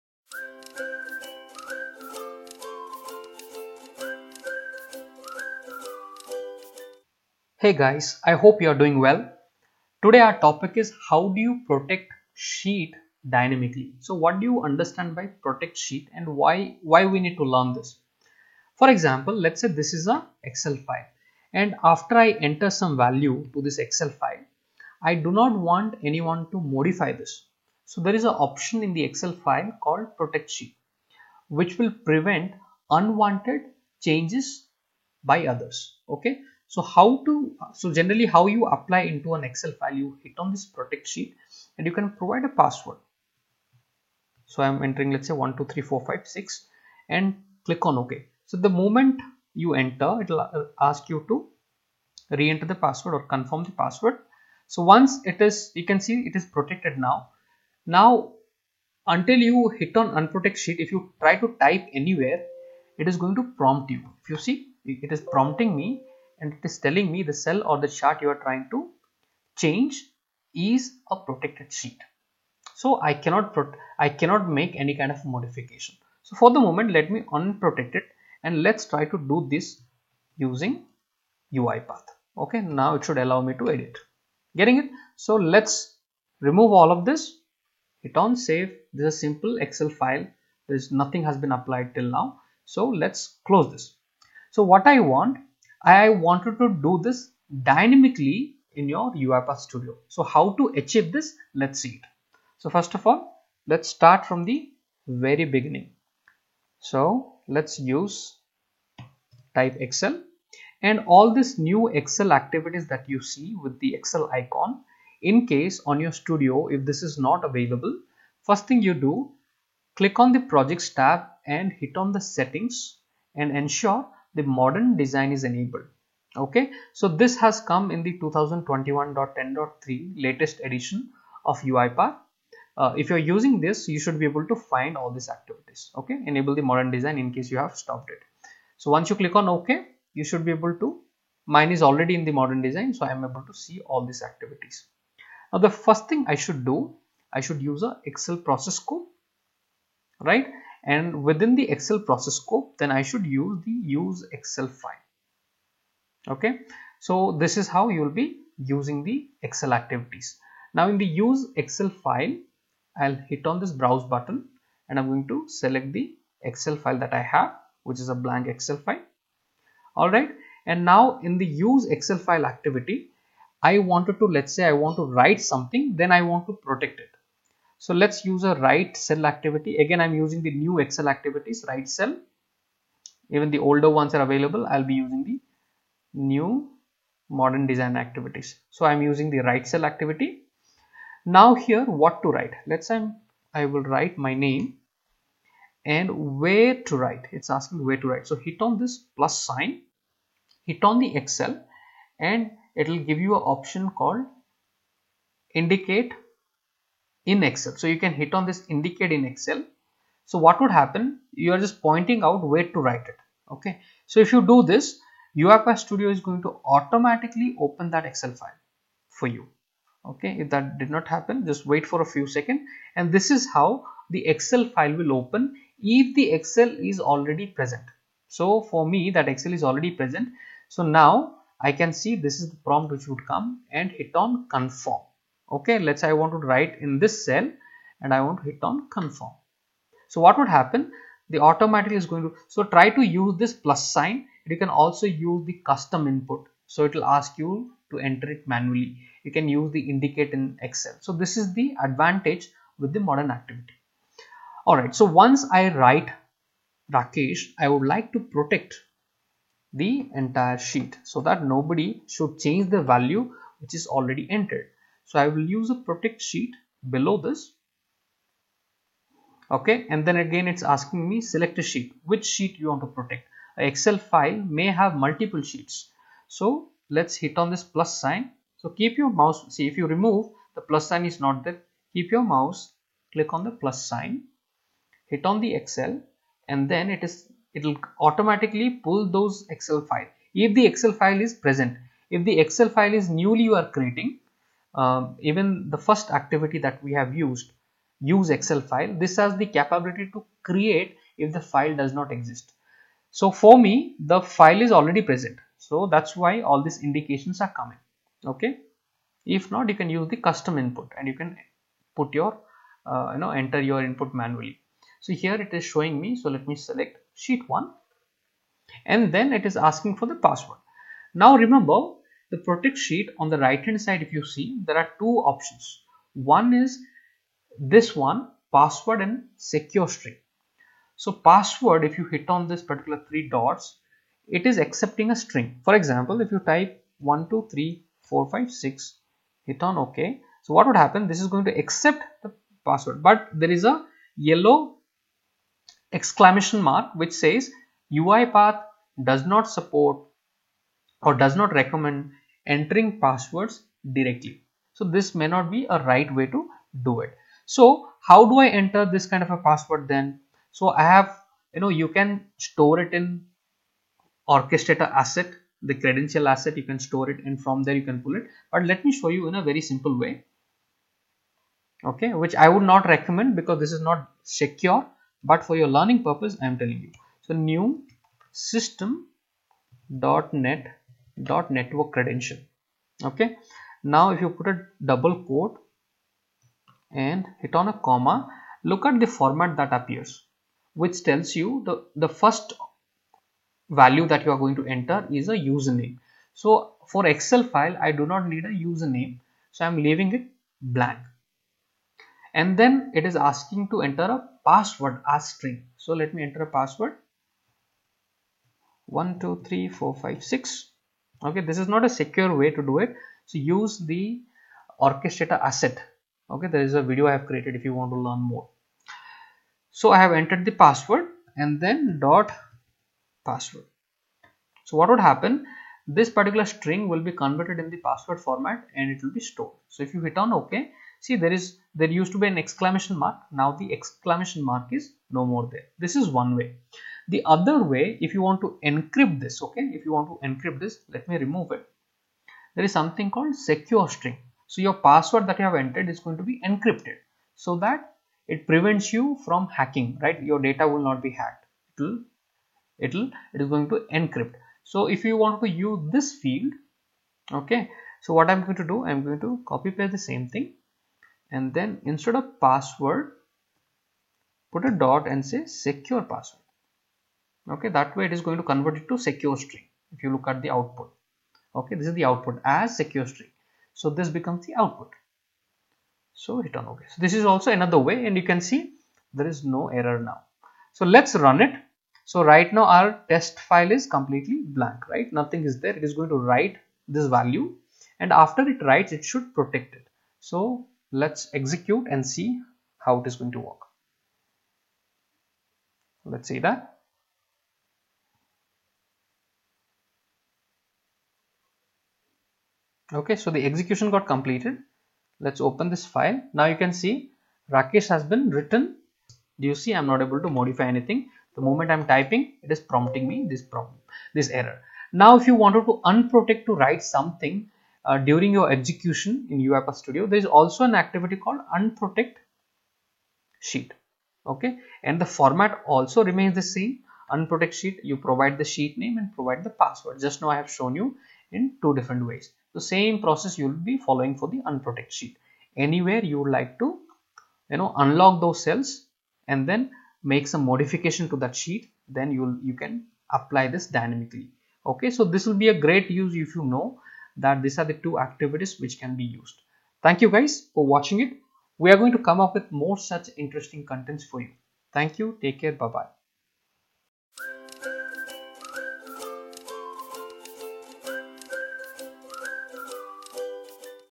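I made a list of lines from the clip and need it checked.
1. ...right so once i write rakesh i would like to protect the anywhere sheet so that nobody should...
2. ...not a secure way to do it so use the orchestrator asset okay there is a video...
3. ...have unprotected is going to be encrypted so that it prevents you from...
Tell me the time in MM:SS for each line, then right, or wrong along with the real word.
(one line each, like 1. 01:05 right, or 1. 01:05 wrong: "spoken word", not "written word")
1. 04:14 wrong: "entire", not "anywhere"
2. 06:51 right
3. 07:25 wrong: "entered", not "unprotected".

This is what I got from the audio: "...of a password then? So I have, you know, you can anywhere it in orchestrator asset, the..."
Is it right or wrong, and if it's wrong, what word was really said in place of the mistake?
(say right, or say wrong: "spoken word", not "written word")
wrong: "store", not "anywhere".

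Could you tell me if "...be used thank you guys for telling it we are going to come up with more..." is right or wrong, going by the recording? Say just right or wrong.
wrong.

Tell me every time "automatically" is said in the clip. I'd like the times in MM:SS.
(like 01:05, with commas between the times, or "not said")
03:36, 04:01, 04:48.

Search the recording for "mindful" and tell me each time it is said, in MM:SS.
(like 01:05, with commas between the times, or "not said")
not said.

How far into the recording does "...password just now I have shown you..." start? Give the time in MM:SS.
08:49.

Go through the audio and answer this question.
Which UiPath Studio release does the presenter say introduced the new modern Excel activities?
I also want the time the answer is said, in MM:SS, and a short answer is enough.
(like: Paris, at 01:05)
2021.10.3, at 02:08.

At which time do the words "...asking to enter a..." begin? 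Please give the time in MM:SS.
06:43.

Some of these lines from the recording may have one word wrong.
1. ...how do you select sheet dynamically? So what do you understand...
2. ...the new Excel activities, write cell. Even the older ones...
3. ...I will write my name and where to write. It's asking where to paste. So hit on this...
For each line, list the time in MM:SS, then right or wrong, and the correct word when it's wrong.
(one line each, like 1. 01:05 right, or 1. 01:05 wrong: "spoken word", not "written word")
1. 00:11 wrong: "protect", not "select"
2. 03:00 right
3. 03:13 wrong: "write", not "paste".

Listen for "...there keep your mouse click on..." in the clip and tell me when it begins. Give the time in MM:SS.
04:41.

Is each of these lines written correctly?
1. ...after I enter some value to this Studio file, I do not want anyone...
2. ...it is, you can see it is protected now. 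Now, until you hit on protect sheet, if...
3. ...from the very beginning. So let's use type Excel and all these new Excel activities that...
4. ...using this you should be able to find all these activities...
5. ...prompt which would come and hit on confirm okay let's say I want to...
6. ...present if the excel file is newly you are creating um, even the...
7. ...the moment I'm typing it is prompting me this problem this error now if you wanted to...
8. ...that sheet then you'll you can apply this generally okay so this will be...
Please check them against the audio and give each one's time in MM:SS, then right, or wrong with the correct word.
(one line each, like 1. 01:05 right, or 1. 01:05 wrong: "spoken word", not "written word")
1. 00:21 wrong: "Excel", not "Studio"
2. 00:55 wrong: "unprotect", not "protect"
3. 01:44 right
4. 02:13 right
5. 03:52 right
6. 04:51 right
7. 08:31 right
8. 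09:01 wrong: "dynamically", not "generally".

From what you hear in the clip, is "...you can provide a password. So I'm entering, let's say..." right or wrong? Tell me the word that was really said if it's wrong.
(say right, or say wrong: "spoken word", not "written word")
right.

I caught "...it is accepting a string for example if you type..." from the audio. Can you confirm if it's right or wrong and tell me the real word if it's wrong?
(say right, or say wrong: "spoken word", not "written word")
right.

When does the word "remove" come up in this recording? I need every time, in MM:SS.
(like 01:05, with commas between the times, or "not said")
01:26, 04:39, 07:21.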